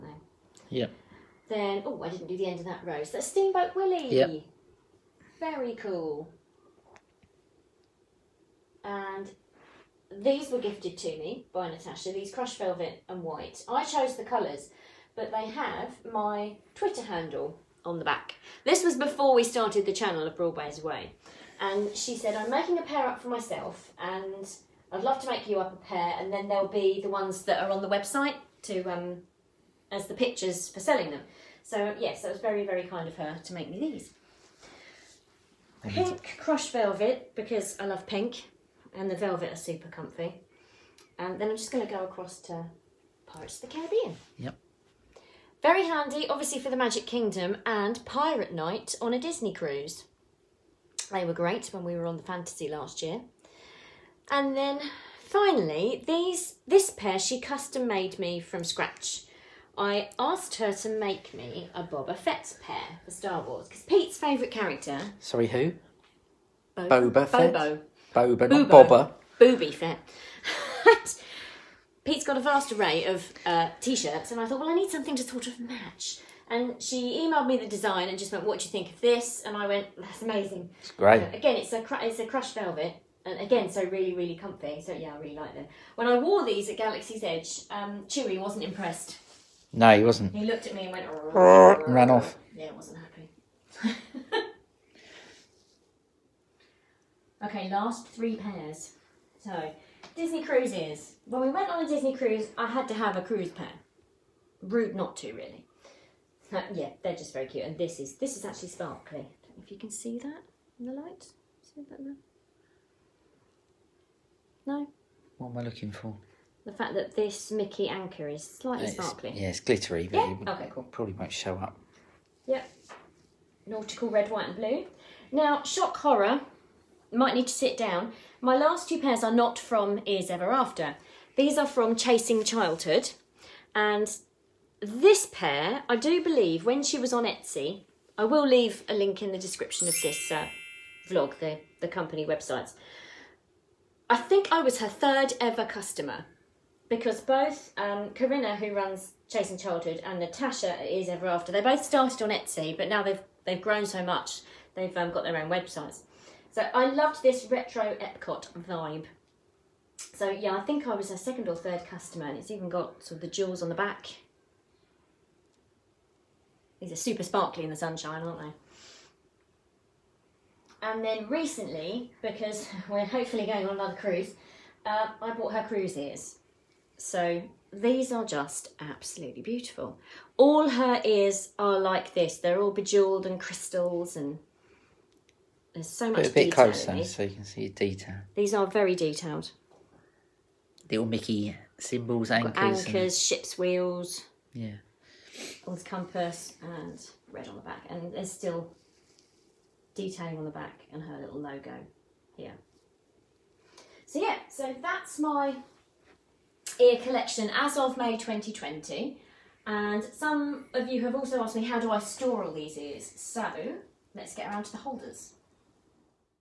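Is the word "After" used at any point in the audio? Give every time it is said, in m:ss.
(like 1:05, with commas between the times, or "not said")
2:10, 2:31.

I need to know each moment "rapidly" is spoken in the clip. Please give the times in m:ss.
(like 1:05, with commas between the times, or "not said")
not said.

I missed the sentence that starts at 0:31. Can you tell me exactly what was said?
So yes, that was very, very kind of her to make me these.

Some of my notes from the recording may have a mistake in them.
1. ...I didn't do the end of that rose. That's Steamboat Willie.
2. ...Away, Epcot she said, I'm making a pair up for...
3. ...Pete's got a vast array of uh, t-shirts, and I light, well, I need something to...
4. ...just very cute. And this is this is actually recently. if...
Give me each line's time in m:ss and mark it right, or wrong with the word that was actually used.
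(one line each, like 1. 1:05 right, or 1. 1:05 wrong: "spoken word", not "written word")
1. 0:02 right
2. 0:20 wrong: "And", not "Epcot"
3. 1:12 wrong: "thought", not "light"
4. 1:47 wrong: "sparkly", not "recently".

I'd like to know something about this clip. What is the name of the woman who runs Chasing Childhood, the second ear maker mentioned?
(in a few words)
Corinna.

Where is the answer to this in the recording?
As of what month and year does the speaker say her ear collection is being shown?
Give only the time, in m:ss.
3:27.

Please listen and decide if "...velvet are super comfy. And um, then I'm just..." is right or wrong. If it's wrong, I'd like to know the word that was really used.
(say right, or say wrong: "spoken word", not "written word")
right.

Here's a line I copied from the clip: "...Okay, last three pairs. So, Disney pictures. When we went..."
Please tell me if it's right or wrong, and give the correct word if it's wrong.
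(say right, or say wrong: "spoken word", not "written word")
wrong: "cruises", not "pictures".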